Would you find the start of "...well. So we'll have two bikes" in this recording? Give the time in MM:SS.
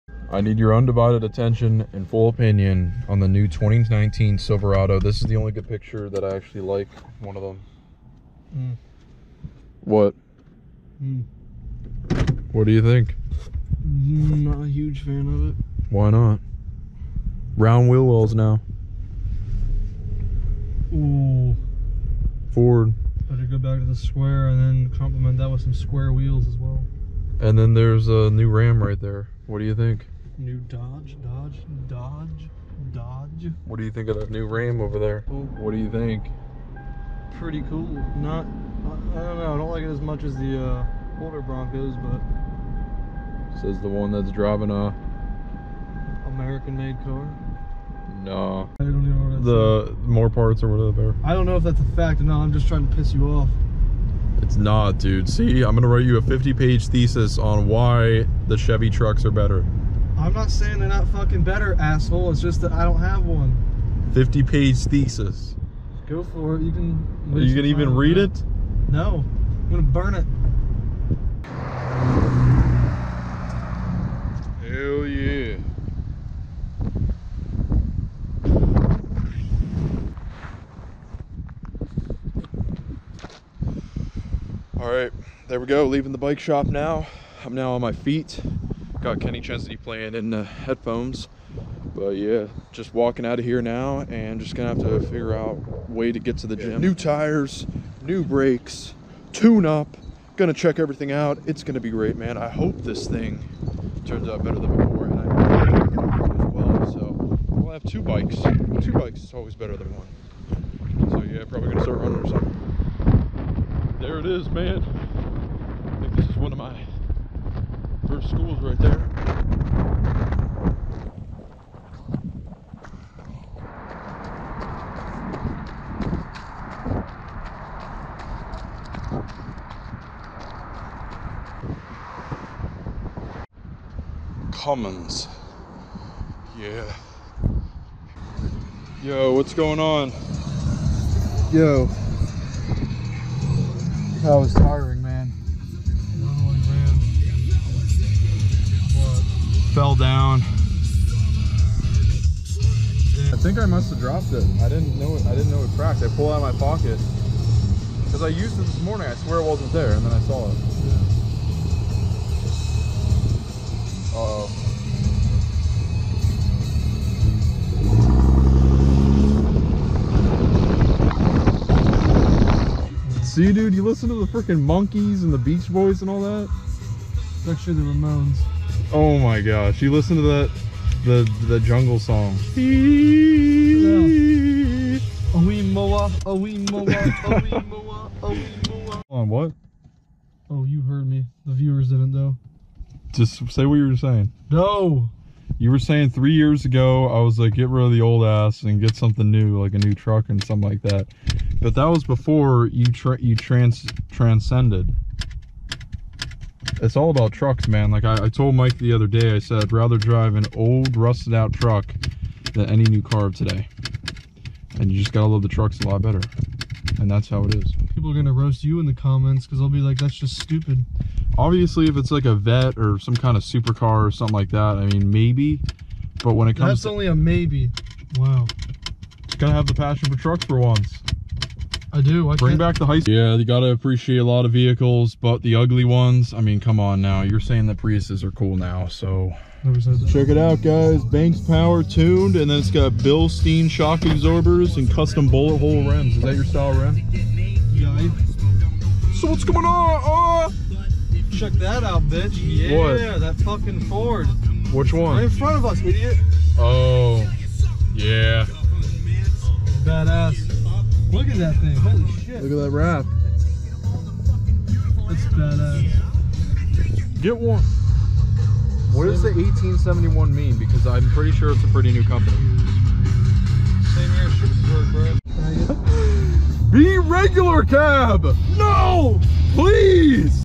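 01:46.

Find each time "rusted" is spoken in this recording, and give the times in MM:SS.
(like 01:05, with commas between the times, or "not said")
03:30.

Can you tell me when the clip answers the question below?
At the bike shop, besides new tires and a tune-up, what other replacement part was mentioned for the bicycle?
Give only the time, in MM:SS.
01:38.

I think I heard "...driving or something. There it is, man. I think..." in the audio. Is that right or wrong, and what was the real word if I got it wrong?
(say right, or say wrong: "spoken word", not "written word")
wrong: "running", not "driving".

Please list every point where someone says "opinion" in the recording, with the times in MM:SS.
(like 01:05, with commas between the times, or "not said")
00:02.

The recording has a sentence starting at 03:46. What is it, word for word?
But when it comes that's to, only a maybe.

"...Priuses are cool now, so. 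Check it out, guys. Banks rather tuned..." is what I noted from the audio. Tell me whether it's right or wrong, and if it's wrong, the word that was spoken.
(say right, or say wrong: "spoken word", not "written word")
wrong: "power", not "rather".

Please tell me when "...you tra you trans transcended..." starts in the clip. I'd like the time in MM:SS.
03:22.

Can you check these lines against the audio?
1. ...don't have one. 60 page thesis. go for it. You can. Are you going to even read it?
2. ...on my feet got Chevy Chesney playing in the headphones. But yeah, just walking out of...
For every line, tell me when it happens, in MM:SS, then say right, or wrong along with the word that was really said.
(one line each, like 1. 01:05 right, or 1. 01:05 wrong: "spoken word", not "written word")
1. 01:02 wrong: "50", not "60"
2. 01:27 wrong: "Kenny", not "Chevy".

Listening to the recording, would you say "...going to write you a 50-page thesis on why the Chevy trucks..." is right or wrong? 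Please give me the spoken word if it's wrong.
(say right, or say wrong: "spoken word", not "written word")
right.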